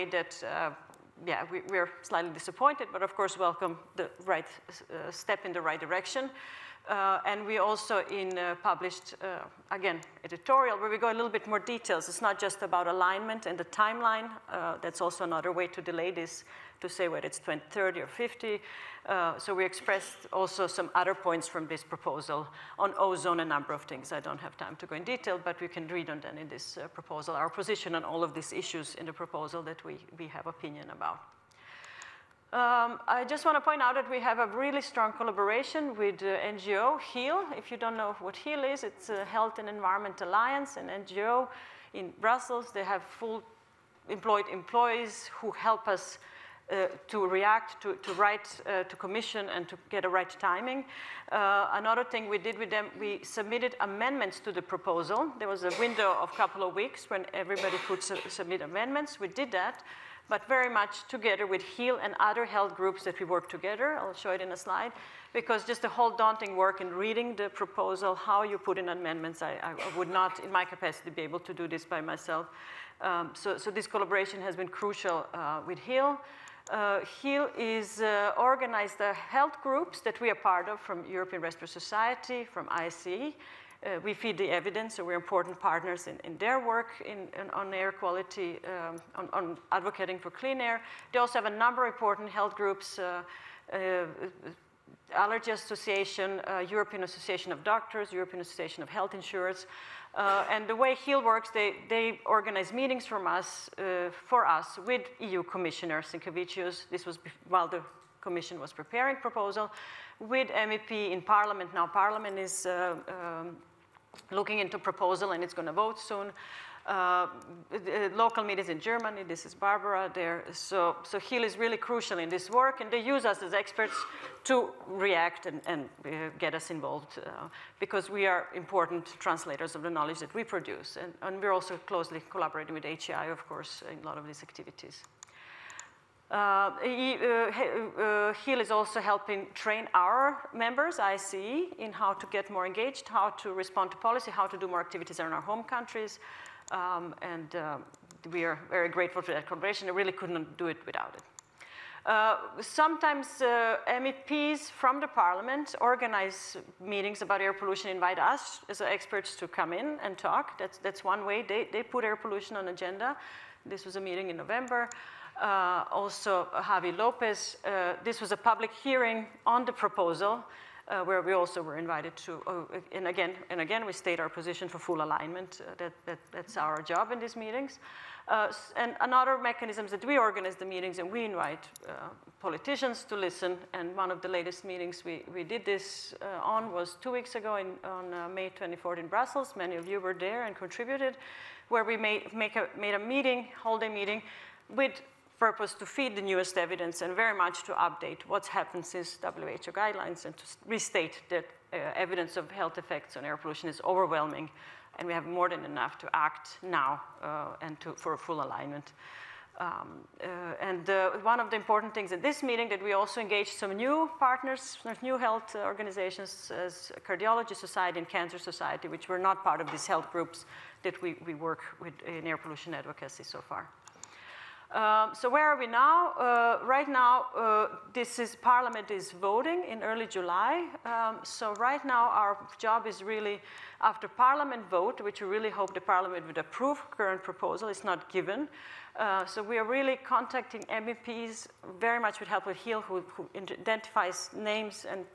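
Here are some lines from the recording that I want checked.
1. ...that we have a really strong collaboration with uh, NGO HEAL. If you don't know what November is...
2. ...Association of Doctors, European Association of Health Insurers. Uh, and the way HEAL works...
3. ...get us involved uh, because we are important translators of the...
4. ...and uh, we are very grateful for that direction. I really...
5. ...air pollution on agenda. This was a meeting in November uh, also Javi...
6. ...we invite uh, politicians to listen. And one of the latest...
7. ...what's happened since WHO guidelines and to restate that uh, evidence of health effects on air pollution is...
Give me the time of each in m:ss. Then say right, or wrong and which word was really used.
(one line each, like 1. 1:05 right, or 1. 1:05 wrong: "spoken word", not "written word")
1. 0:33 wrong: "HEAL", not "November"
2. 1:37 right
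3. 2:06 right
4. 2:27 wrong: "collaboration", not "direction"
5. 2:42 right
6. 3:01 right
7. 3:18 right.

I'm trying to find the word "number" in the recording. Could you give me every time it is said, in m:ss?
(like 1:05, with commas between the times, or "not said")
0:23, 1:31.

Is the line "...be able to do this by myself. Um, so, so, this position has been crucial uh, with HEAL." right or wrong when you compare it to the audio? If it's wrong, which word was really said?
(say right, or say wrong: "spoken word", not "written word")
wrong: "collaboration", not "position".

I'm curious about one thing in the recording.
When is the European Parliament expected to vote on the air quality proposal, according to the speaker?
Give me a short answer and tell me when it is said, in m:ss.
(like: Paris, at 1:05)
early July, at 3:49.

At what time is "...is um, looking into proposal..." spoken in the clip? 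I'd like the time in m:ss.
1:52.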